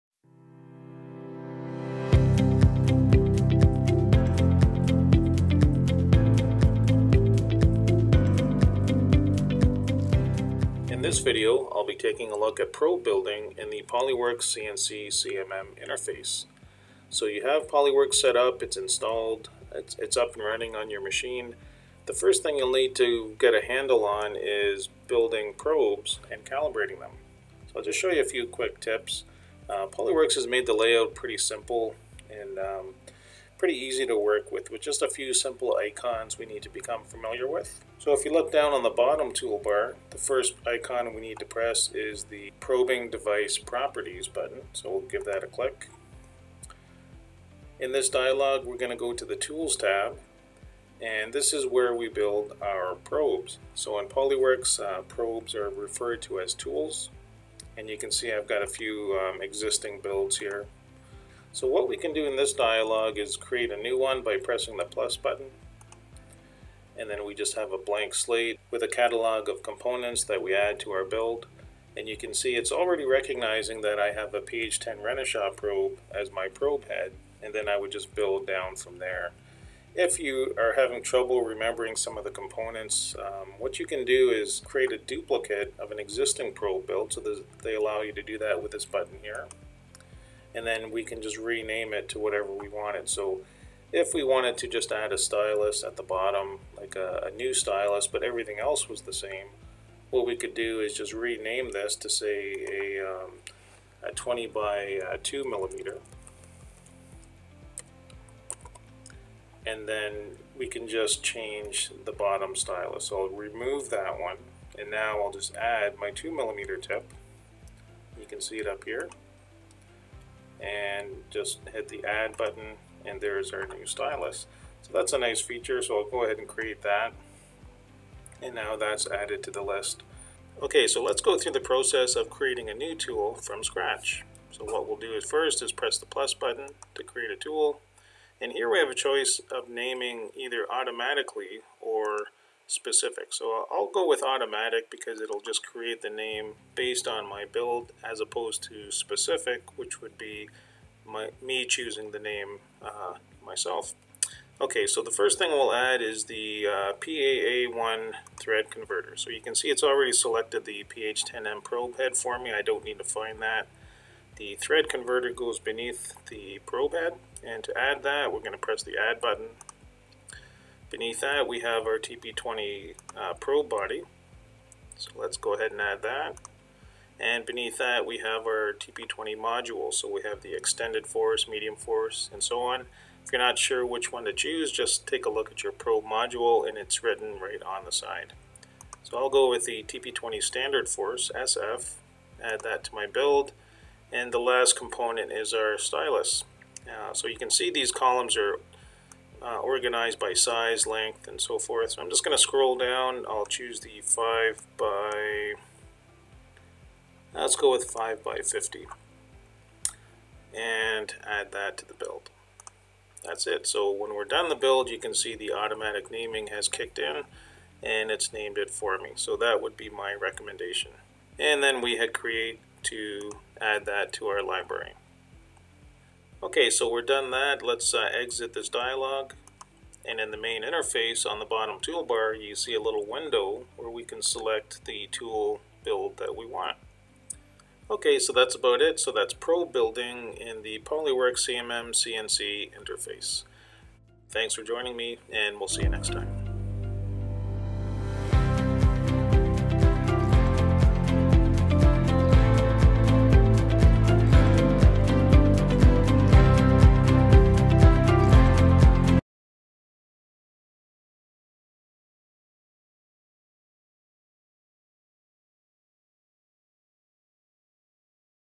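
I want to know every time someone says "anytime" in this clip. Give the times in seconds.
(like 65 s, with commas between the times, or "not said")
not said.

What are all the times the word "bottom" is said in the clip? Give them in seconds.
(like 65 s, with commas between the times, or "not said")
38 s, 96 s, 112 s, 231 s.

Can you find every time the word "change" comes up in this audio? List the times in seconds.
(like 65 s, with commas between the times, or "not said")
111 s.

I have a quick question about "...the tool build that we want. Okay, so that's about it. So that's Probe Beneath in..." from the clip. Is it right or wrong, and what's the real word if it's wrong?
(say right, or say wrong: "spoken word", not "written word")
wrong: "Building", not "Beneath".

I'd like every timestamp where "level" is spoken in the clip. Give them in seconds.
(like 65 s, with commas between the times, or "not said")
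not said.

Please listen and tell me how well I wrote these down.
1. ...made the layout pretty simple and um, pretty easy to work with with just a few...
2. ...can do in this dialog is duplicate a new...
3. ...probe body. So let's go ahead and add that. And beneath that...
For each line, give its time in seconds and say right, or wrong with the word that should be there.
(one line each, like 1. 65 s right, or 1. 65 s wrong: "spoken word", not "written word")
1. 30 s right
2. 61 s wrong: "create", not "duplicate"
3. 173 s right.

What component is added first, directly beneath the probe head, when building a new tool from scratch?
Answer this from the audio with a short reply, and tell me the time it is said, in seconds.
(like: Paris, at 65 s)
PAA1 thread converter, at 156 s.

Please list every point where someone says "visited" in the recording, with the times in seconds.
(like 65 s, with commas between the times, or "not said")
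not said.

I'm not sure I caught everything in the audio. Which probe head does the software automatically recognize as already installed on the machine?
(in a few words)
PH10 Renishaw.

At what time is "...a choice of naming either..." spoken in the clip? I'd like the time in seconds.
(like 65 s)
138 s.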